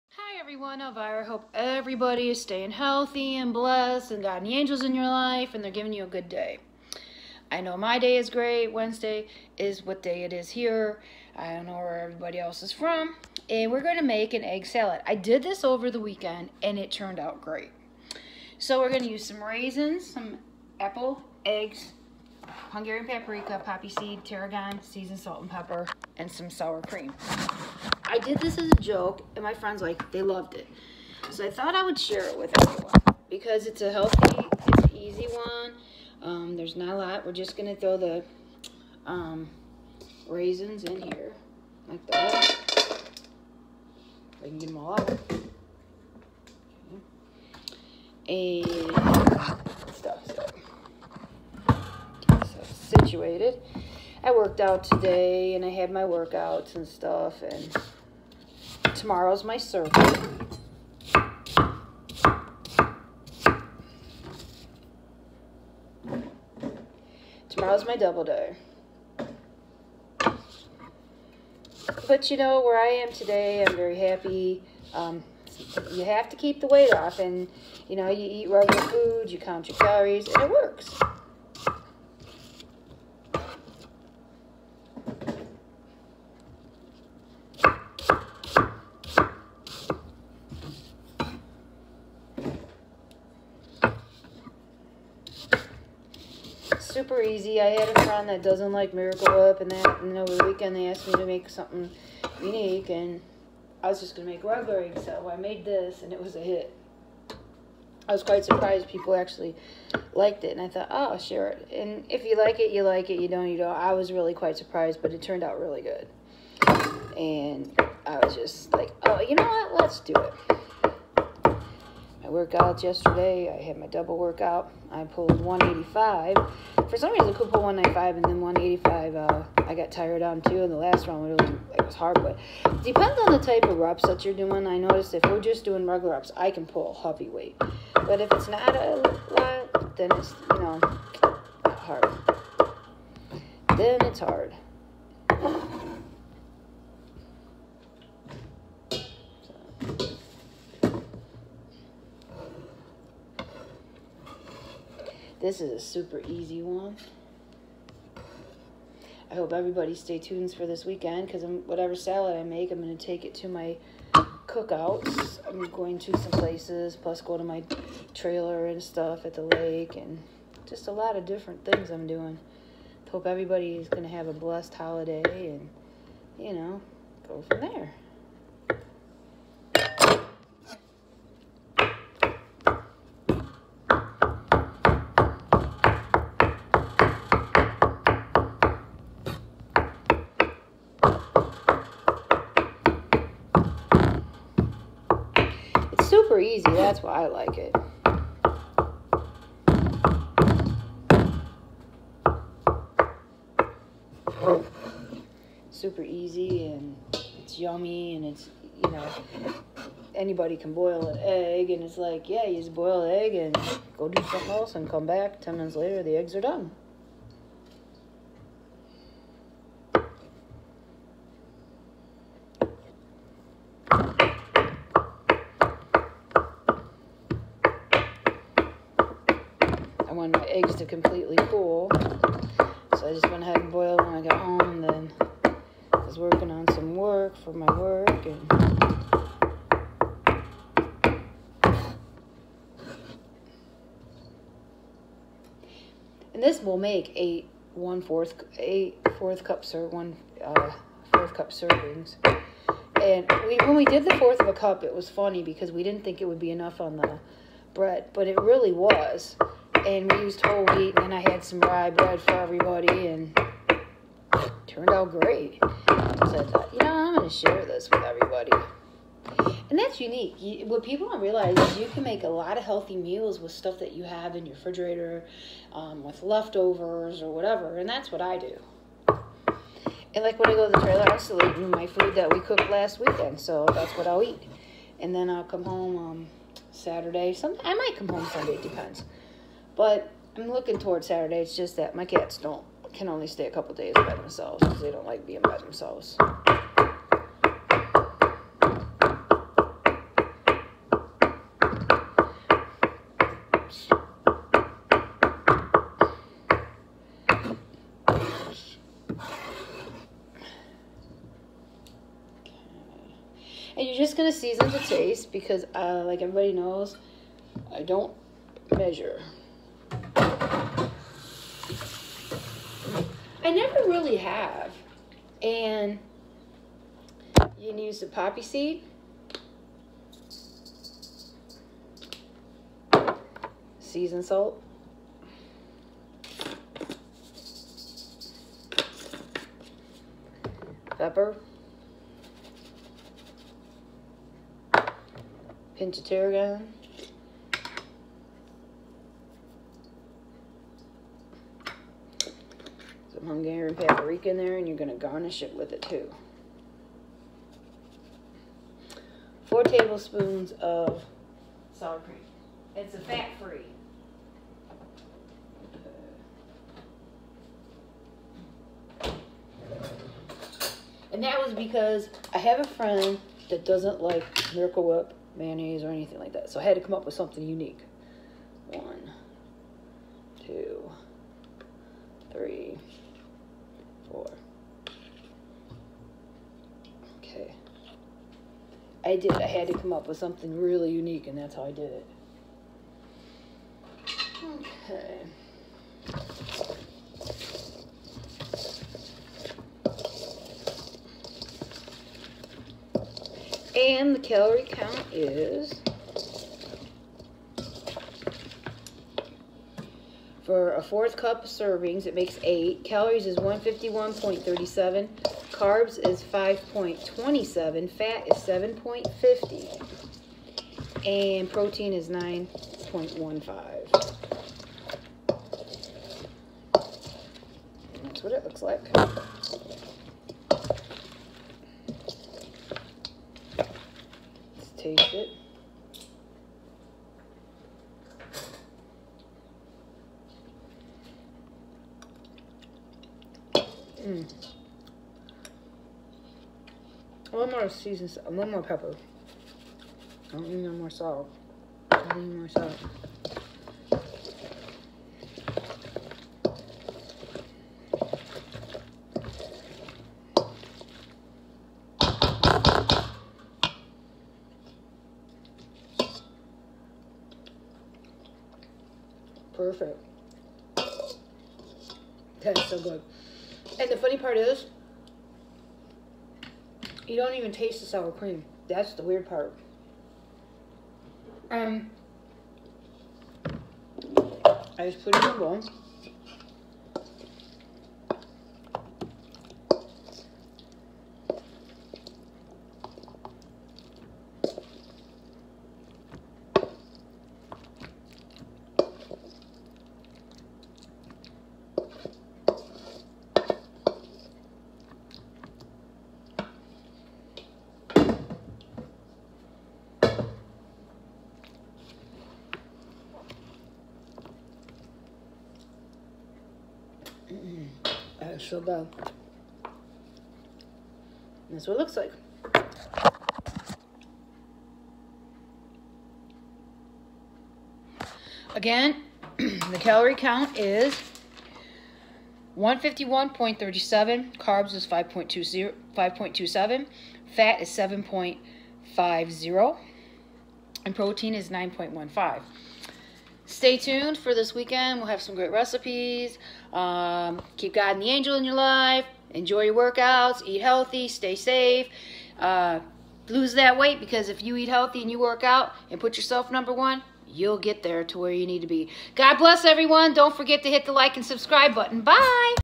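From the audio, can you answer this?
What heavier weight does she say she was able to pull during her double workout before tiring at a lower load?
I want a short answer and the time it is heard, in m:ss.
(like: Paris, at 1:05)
195, at 2:07.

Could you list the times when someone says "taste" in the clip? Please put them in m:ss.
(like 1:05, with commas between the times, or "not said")
5:14, 7:14, 7:57.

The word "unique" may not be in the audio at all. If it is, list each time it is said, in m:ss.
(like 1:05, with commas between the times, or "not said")
1:42, 4:30, 6:17, 6:30.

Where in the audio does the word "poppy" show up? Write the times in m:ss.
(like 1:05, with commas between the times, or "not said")
0:23, 5:28.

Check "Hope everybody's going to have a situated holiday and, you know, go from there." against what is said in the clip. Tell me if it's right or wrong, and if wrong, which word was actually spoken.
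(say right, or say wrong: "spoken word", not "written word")
wrong: "blessed", not "situated".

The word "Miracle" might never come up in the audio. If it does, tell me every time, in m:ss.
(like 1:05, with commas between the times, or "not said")
1:38, 6:14.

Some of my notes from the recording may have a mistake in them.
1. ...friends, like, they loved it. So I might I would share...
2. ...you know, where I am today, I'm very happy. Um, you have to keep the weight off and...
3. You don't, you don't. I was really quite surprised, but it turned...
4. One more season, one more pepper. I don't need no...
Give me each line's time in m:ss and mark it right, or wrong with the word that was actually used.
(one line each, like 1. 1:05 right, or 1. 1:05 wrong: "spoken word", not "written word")
1. 0:29 wrong: "thought", not "might"
2. 1:12 right
3. 1:53 right
4. 7:27 right.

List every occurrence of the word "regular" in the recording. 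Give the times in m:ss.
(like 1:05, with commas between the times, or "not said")
1:18, 1:44, 2:15.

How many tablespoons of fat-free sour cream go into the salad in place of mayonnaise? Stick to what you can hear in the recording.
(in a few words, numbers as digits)
4.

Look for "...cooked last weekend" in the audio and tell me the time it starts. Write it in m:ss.
4:42.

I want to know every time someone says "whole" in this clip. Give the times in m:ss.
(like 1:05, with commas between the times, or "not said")
4:20.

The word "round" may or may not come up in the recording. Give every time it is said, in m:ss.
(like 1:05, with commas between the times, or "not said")
2:11.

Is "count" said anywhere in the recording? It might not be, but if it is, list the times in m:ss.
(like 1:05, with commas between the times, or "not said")
1:19, 6:44, 8:50.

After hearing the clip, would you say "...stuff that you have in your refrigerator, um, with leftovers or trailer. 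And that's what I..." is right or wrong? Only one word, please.
wrong.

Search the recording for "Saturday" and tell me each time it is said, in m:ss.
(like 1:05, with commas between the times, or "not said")
4:46, 4:51.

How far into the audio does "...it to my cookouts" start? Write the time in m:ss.
2:43.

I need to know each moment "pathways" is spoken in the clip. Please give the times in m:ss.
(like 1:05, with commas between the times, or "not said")
not said.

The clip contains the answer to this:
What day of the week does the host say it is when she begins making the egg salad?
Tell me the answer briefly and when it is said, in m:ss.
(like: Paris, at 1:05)
Wednesday, at 0:08.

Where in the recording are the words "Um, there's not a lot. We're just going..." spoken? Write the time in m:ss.
0:36.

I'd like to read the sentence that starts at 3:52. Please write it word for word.
So I just went ahead and boiled when I got home.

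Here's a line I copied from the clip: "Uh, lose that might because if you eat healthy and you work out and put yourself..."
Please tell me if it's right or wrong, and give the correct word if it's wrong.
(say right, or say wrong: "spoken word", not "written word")
wrong: "weight", not "might".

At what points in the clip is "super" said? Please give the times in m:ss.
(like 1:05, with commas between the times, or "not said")
1:37, 2:35, 3:16, 3:25.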